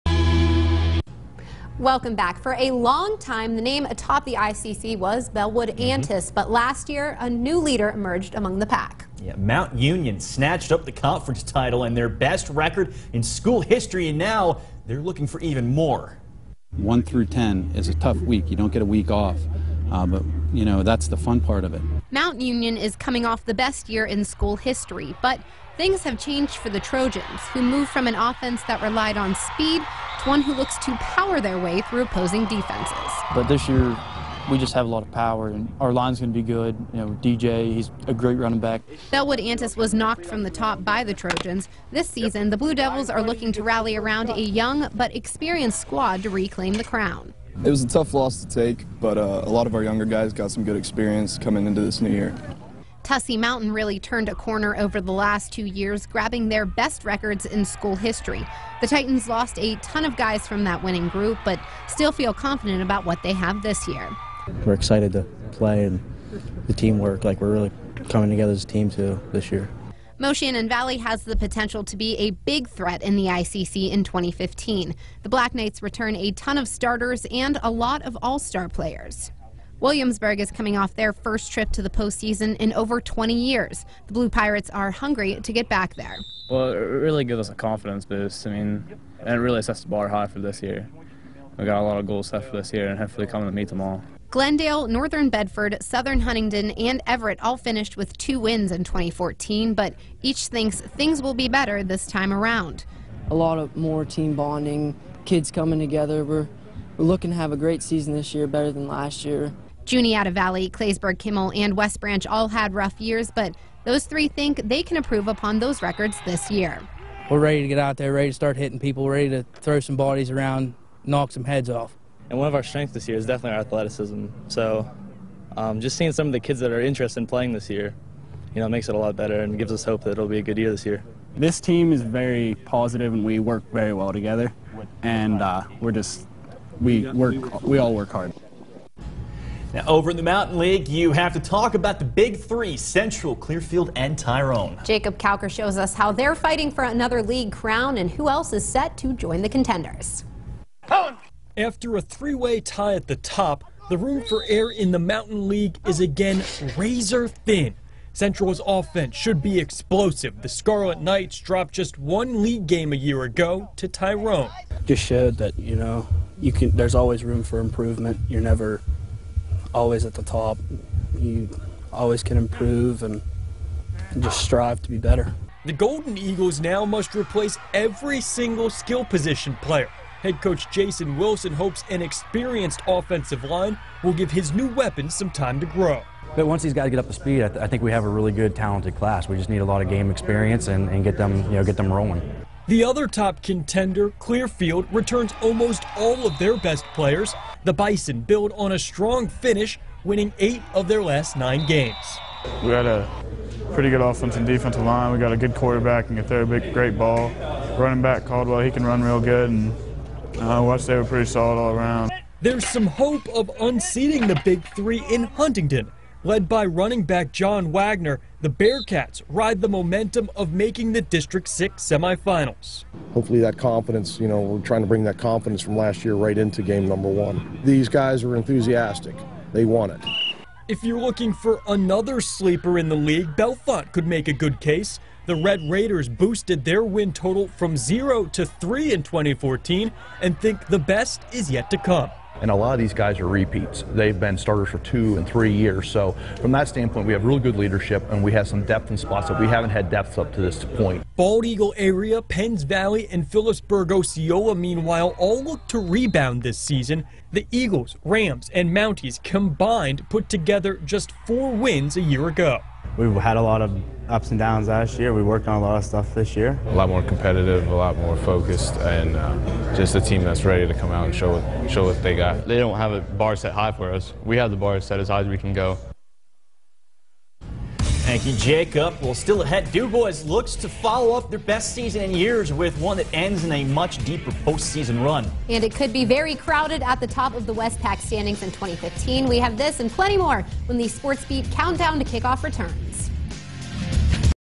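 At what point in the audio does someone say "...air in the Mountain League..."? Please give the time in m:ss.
2:34.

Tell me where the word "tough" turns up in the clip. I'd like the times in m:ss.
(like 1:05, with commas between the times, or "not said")
0:17, 0:47.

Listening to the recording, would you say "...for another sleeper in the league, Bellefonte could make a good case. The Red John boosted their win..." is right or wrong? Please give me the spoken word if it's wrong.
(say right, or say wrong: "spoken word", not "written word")
wrong: "Raiders", not "John".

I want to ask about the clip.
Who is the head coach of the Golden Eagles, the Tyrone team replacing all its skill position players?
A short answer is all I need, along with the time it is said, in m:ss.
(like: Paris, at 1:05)
Jason Wilson, at 3:00.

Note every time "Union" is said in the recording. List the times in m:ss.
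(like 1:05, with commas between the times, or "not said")
0:09, 0:22.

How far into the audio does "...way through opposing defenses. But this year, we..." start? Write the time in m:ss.
0:31.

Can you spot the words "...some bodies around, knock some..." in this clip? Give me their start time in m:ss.
1:59.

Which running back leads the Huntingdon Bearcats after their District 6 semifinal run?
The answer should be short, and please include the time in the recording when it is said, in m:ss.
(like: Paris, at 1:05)
John Wagner, at 3:37.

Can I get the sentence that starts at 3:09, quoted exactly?
We just need a lot of game experience and, and get them, you know, get them rolling.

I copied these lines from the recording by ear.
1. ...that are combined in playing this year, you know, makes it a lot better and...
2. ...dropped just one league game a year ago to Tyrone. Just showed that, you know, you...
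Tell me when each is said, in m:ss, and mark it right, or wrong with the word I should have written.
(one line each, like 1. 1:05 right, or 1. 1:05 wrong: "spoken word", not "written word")
1. 2:06 wrong: "interested", not "combined"
2. 2:41 right.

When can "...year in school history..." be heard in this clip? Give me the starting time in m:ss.
0:23.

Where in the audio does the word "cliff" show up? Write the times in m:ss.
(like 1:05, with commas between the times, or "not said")
not said.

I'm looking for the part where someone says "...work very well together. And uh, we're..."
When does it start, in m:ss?
2:13.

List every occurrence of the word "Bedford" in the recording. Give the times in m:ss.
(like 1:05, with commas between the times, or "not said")
1:35.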